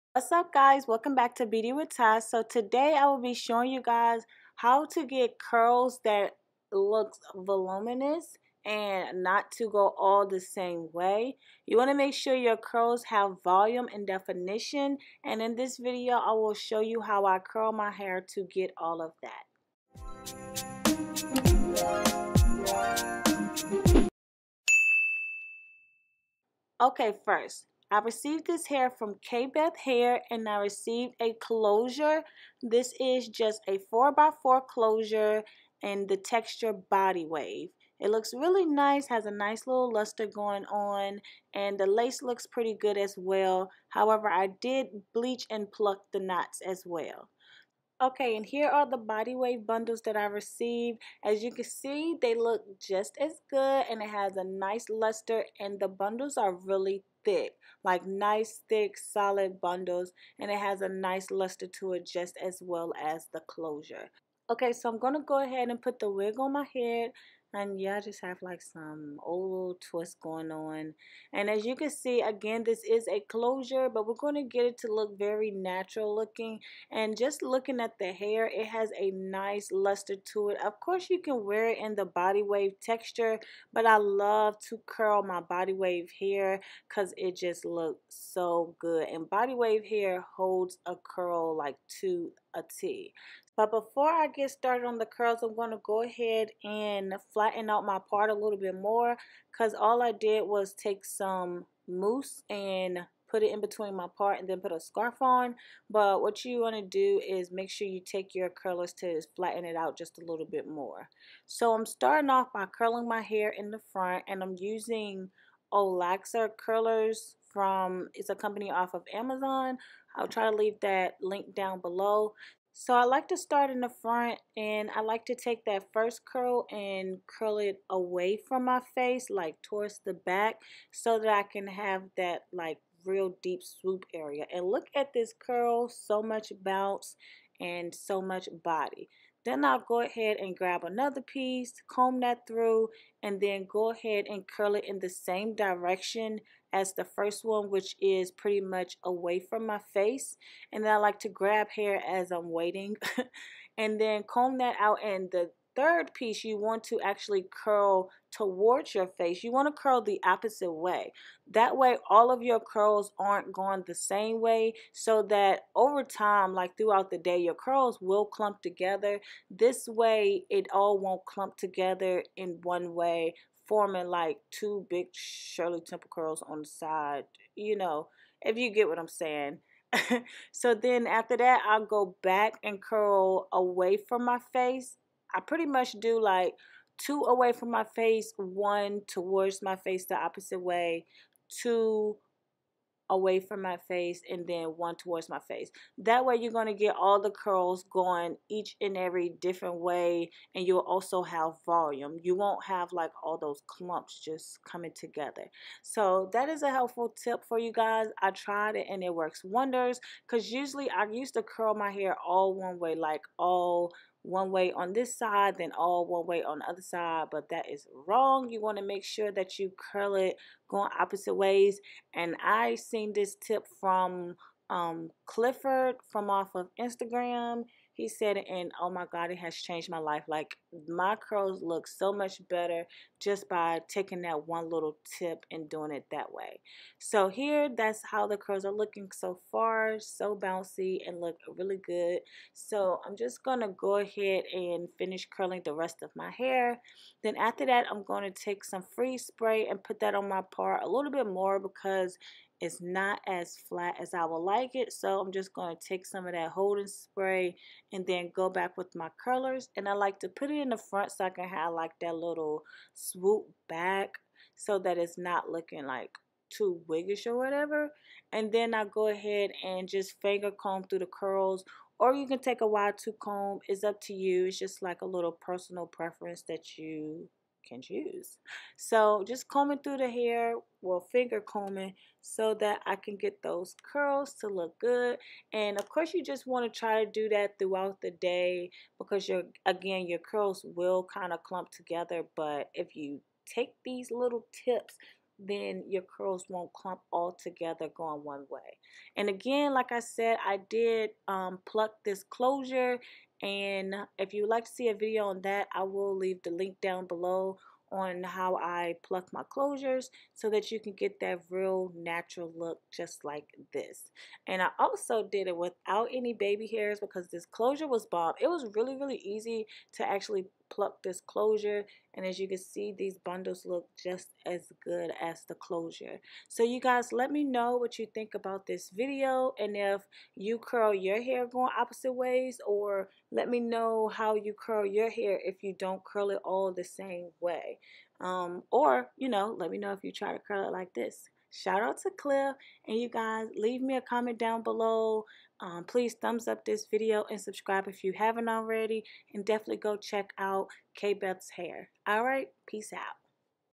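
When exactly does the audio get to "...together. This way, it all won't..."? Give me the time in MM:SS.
02:48.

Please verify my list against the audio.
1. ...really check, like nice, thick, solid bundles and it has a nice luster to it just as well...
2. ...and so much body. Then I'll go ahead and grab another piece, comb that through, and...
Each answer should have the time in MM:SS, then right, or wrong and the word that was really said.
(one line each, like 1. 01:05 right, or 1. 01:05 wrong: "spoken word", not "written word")
1. 00:56 wrong: "thick", not "check"
2. 02:17 right.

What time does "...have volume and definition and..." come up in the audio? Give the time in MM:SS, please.
00:13.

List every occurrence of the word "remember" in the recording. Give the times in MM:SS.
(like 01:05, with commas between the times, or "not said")
not said.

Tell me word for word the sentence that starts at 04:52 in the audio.
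But if you take these little tips then your curls won't clump all together going one way.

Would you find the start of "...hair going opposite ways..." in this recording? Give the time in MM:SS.
05:31.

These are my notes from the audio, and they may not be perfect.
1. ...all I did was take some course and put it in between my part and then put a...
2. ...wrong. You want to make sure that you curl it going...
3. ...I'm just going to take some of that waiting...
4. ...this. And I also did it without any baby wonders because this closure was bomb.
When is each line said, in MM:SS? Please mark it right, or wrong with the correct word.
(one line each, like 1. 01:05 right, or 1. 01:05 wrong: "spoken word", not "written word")
1. 01:39 wrong: "mousse", not "course"
2. 03:38 right
3. 04:15 wrong: "holding", not "waiting"
4. 05:13 wrong: "hairs", not "wonders".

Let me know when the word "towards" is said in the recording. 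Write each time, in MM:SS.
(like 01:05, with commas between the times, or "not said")
02:09, 02:38, 03:09, 03:14.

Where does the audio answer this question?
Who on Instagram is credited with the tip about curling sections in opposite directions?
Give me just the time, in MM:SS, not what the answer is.
03:45.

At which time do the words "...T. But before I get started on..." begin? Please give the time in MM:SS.
01:32.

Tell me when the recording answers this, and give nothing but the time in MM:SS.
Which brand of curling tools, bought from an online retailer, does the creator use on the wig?
01:55.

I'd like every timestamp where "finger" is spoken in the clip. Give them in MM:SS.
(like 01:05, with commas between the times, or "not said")
04:30, 04:41.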